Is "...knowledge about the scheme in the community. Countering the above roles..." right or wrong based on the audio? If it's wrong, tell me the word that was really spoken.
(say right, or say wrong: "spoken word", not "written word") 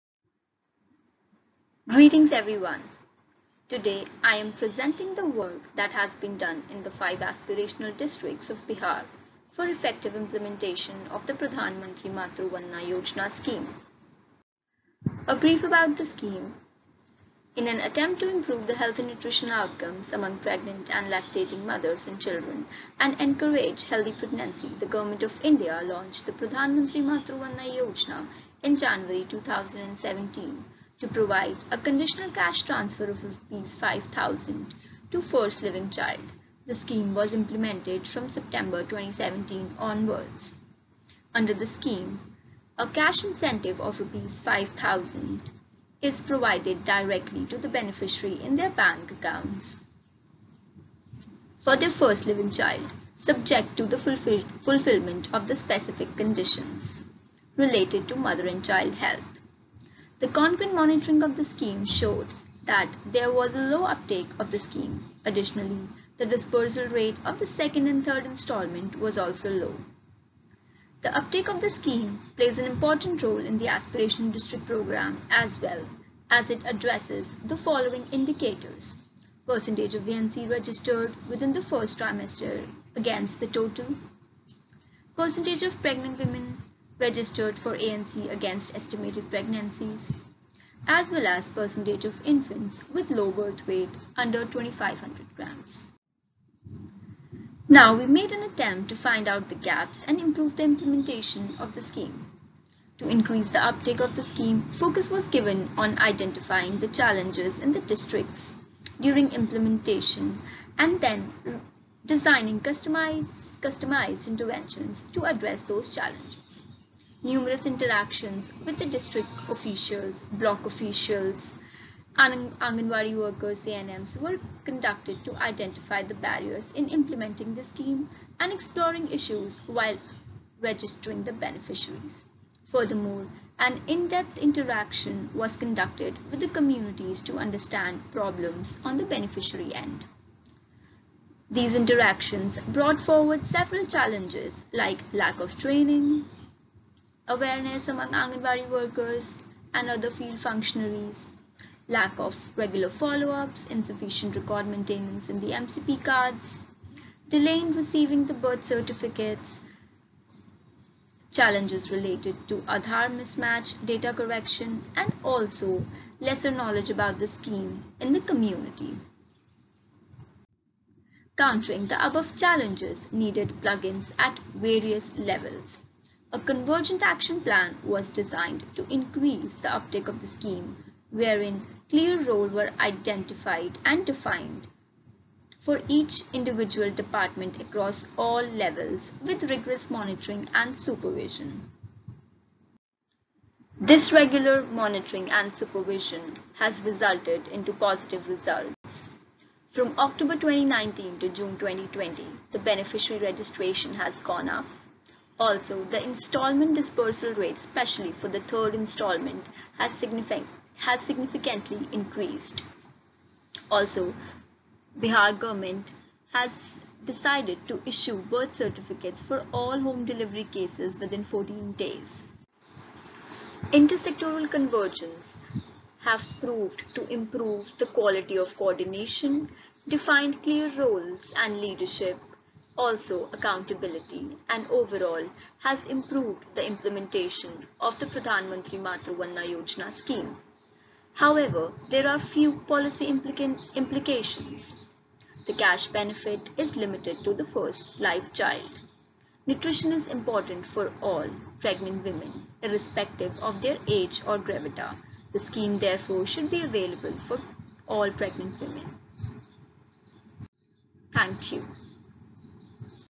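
wrong: "challenges", not "roles".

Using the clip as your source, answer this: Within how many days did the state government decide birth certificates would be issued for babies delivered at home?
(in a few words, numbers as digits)
14 days.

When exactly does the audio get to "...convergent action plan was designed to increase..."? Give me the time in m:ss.
2:56.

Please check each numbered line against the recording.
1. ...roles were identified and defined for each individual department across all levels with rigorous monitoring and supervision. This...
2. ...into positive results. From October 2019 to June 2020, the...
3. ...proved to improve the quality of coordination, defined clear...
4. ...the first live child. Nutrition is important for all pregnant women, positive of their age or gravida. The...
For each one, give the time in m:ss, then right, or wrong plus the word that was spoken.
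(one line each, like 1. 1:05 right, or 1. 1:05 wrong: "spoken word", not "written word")
1. 3:02 right
2. 3:17 right
3. 3:46 right
4. 4:07 wrong: "irrespective", not "positive".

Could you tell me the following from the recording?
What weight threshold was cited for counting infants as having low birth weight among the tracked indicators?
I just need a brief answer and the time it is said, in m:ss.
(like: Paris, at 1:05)
2500 grams, at 1:34.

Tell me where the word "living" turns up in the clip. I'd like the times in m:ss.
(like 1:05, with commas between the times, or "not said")
0:35, 0:52.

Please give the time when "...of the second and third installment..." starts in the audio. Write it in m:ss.
1:07.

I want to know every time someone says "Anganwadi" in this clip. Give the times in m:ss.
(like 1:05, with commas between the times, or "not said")
2:02, 2:28.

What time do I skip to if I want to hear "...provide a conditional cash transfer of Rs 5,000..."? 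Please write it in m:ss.
0:31.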